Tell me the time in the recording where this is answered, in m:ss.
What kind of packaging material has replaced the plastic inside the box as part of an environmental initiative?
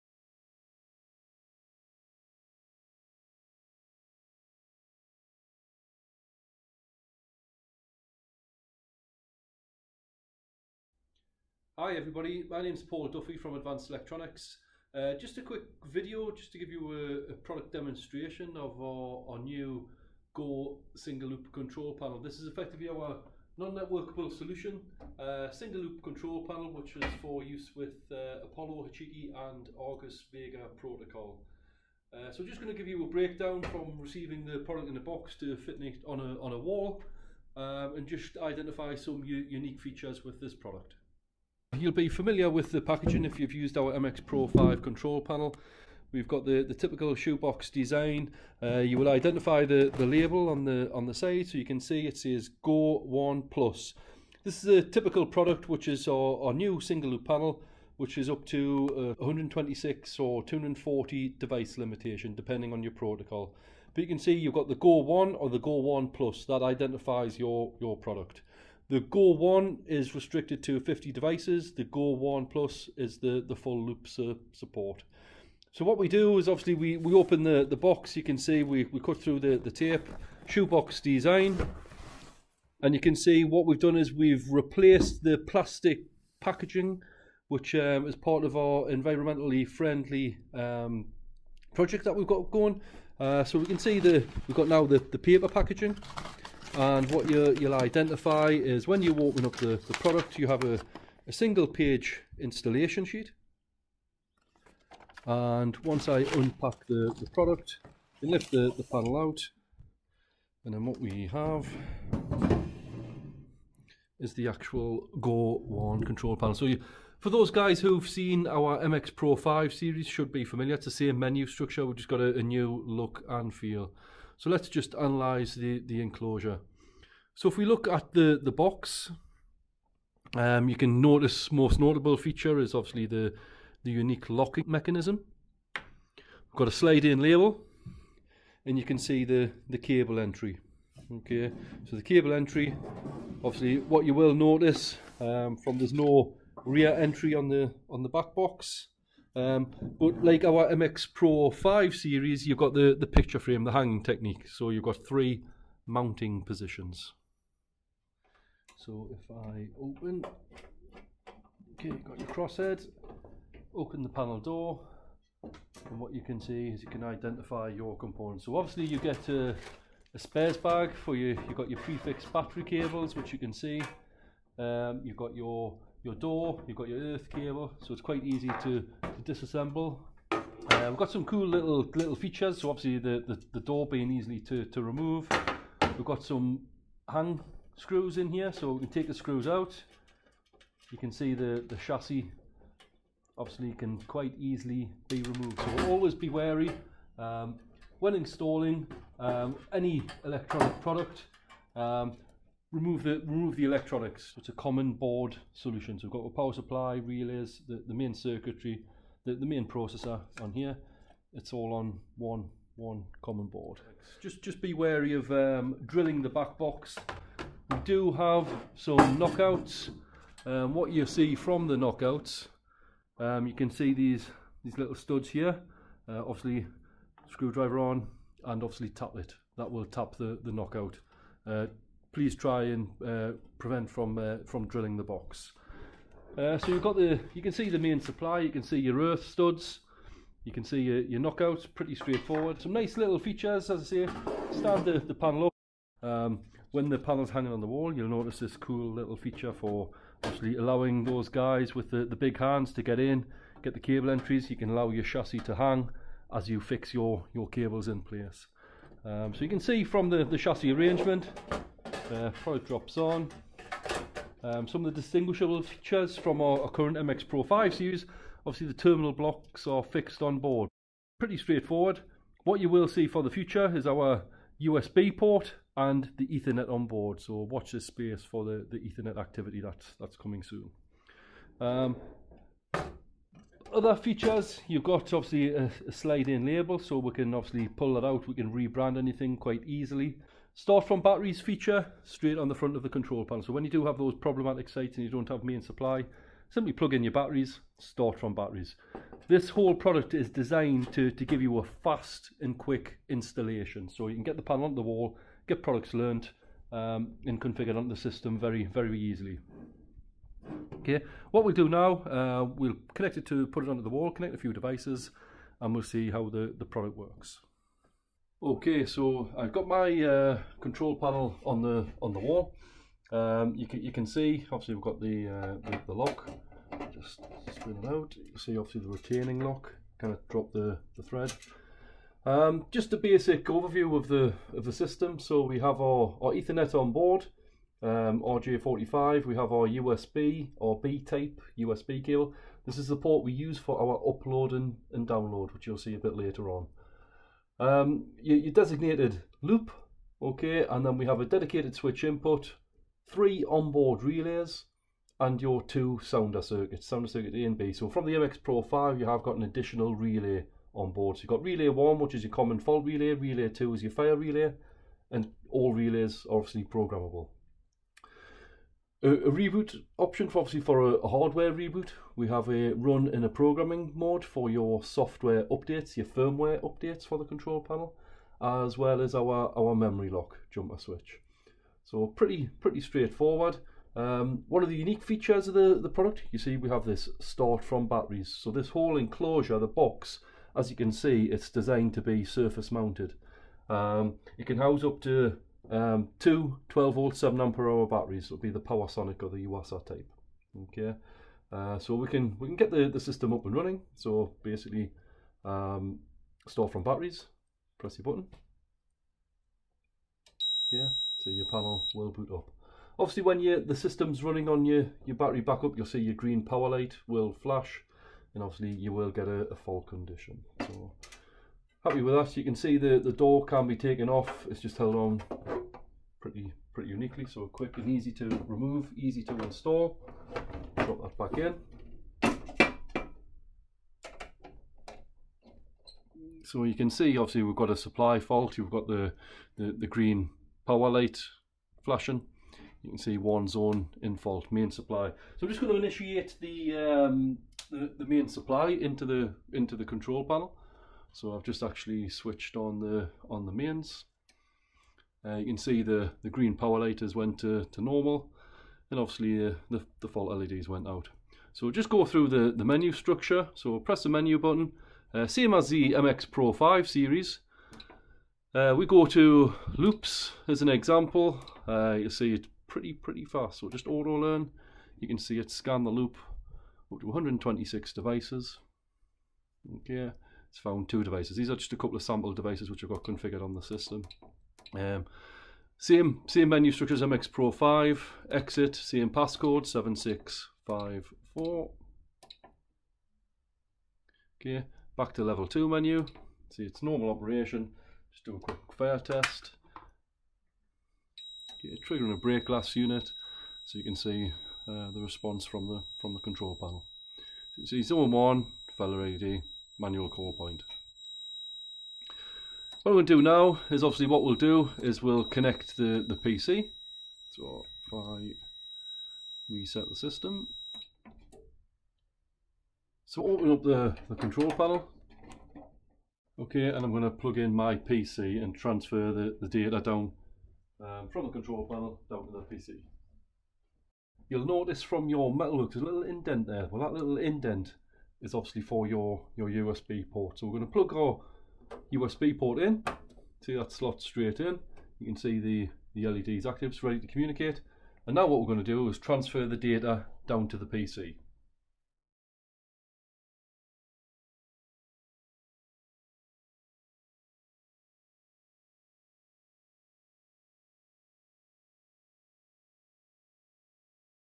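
1:35.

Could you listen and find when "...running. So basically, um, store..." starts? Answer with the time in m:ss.
6:43.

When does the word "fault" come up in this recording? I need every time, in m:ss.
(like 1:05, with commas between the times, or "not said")
6:02, 6:59, 7:18, 7:24, 7:40.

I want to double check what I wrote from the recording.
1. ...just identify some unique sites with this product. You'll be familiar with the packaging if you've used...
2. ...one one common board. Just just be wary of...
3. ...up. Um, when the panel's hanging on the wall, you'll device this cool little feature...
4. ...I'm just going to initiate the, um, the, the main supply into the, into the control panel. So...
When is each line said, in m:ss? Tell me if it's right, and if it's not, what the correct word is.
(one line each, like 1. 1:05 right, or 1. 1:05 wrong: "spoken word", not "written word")
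1. 0:38 wrong: "features", not "sites"
2. 3:32 right
3. 4:05 wrong: "notice", not "device"
4. 7:25 right.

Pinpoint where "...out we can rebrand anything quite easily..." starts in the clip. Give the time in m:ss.
4:48.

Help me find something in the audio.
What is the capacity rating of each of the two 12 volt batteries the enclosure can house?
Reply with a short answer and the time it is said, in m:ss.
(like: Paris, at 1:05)
7 ampere hour, at 6:37.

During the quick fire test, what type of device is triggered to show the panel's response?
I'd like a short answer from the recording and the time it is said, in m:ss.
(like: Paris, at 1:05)
break glass unit, at 8:22.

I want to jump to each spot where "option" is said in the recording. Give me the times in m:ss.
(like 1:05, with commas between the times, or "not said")
6:09.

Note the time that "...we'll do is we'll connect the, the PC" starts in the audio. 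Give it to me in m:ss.
8:34.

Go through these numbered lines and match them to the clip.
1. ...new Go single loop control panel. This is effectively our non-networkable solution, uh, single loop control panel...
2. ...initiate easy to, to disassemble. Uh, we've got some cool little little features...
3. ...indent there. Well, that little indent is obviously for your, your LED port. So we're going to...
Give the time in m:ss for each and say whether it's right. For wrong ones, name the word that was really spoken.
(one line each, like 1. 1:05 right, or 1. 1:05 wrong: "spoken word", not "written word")
1. 0:19 right
2. 2:58 wrong: "quite", not "initiate"
3. 8:56 wrong: "USB", not "LED".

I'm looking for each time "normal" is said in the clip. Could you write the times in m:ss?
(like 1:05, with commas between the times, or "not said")
7:37, 8:16.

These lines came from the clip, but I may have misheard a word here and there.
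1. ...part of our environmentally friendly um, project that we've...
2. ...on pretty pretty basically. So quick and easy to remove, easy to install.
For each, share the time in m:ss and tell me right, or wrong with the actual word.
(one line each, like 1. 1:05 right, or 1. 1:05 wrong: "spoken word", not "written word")
1. 1:28 right
2. 7:04 wrong: "uniquely", not "basically".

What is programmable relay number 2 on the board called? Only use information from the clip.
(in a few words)
fire relay.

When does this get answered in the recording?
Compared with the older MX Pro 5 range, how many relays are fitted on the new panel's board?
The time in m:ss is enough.
5:53.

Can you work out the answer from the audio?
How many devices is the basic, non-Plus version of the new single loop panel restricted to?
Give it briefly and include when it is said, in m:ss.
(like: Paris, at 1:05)
50, at 1:10.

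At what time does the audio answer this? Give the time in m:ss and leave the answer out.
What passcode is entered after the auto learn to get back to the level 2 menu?
8:09.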